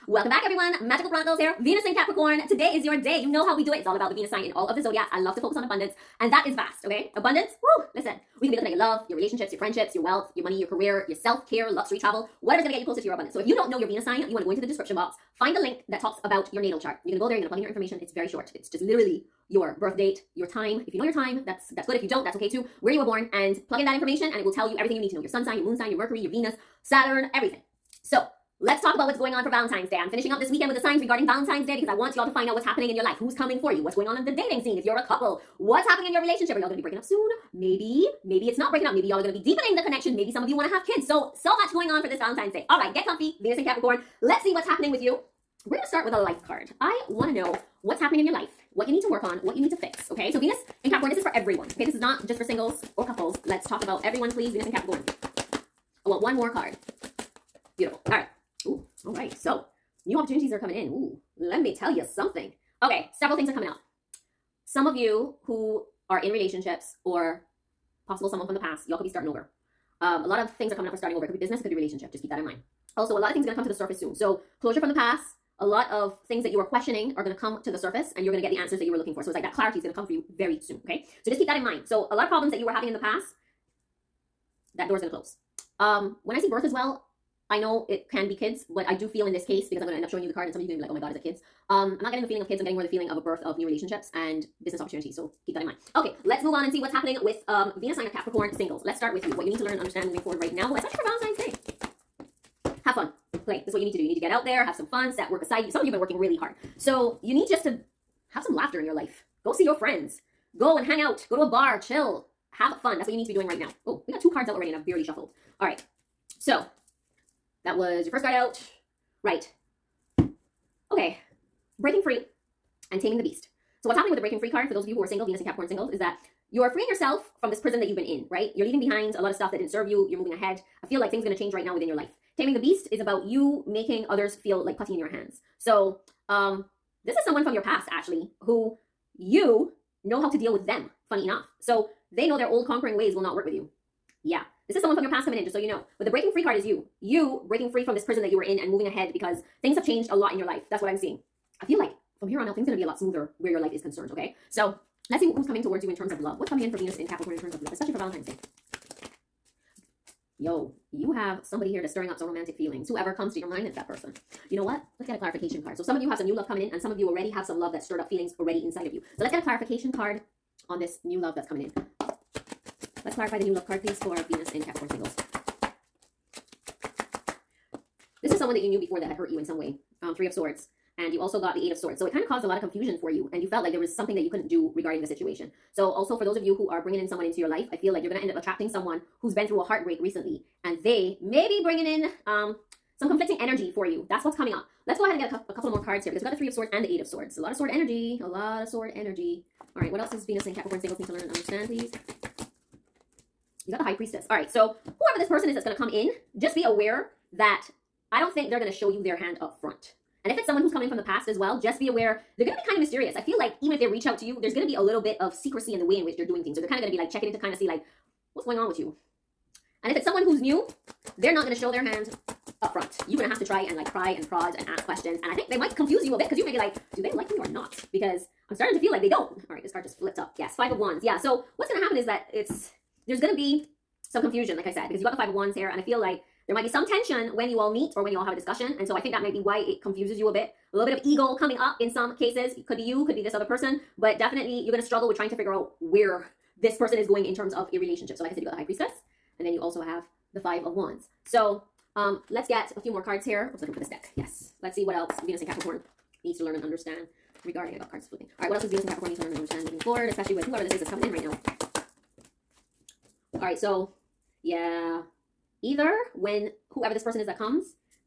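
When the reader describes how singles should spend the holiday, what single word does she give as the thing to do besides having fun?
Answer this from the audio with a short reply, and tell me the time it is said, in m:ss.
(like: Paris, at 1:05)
Play, at 1:43.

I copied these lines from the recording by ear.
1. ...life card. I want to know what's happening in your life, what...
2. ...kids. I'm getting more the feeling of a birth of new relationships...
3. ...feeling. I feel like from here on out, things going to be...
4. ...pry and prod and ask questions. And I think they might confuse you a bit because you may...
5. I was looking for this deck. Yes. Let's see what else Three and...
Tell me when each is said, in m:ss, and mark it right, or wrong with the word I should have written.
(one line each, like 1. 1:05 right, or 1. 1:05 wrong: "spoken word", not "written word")
1. 0:46 right
2. 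1:32 right
3. 2:30 wrong: "seeing", not "feeling"
4. 3:43 right
5. 4:13 wrong: "Venus", not "Three".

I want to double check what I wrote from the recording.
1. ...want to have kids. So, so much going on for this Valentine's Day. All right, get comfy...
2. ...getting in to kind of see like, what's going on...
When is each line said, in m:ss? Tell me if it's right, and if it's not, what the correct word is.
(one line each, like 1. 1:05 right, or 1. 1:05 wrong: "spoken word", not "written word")
1. 0:40 right
2. 3:37 wrong: "checking", not "getting".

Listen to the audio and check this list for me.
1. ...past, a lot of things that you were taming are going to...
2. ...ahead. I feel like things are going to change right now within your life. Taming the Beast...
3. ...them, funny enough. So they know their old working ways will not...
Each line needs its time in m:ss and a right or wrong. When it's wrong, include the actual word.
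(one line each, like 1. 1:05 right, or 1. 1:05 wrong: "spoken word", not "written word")
1. 1:14 wrong: "questioning", not "taming"
2. 2:10 right
3. 2:20 wrong: "conquering", not "working".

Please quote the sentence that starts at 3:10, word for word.
And they may be bringing in um, some conflicting energy for you.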